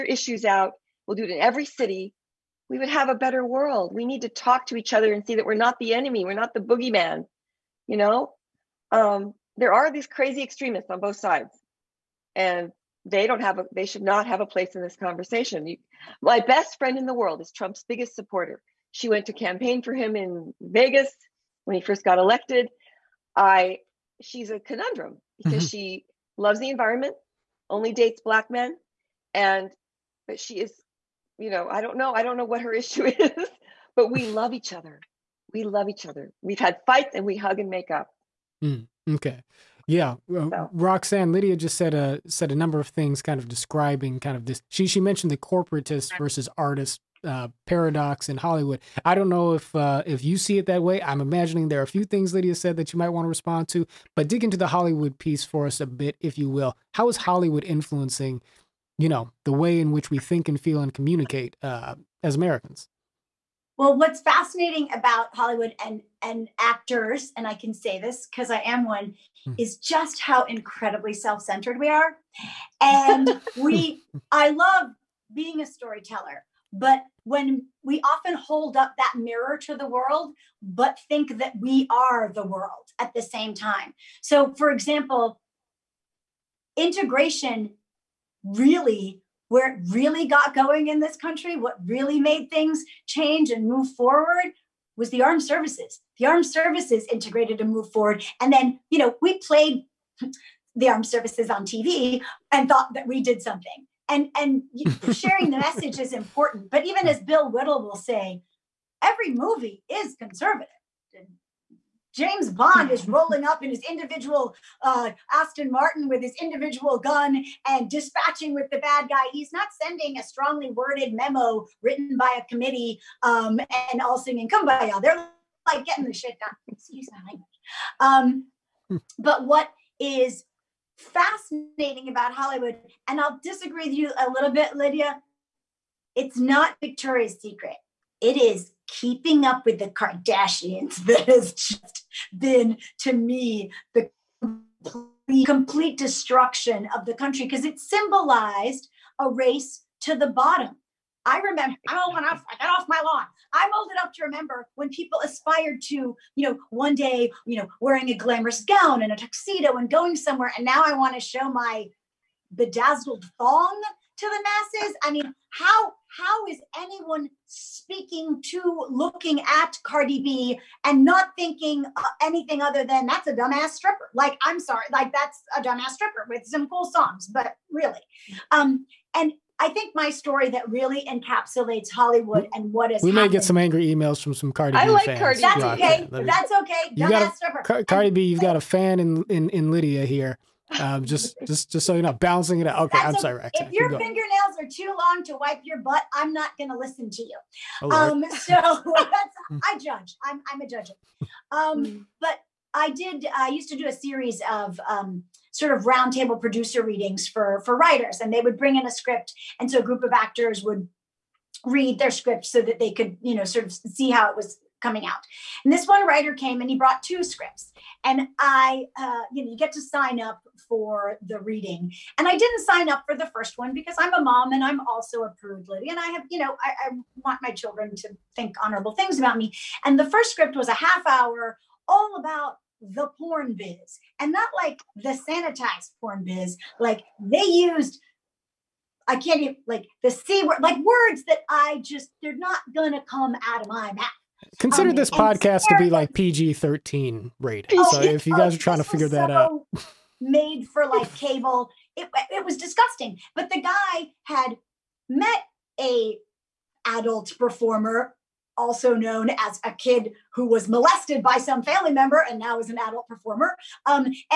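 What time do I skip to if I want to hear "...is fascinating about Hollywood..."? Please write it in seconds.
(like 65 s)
129 s.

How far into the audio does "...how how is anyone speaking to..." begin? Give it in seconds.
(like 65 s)
165 s.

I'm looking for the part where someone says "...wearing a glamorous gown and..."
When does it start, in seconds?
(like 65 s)
157 s.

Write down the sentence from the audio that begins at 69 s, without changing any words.
is just how incredibly self-centered we are.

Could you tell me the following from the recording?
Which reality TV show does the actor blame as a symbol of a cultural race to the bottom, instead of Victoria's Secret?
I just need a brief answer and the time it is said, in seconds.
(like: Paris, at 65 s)
Keeping Up with the Kardashians, at 138 s.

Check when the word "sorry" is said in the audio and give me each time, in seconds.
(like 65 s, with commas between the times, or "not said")
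174 s, 193 s.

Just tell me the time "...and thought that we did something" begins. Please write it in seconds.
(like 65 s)
102 s.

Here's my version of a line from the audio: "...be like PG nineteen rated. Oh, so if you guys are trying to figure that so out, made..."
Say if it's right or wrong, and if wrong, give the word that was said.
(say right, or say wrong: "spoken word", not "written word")
wrong: "thirteen", not "nineteen".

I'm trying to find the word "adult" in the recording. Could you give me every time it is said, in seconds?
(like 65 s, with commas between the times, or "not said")
256 s, 262 s.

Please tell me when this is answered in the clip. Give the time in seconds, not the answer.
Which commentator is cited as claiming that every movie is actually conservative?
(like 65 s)
107 s.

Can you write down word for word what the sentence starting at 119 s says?
He's not sending a strongly worded memo written by a committee um, and all singing "Kumbaya." They're like getting the shit done.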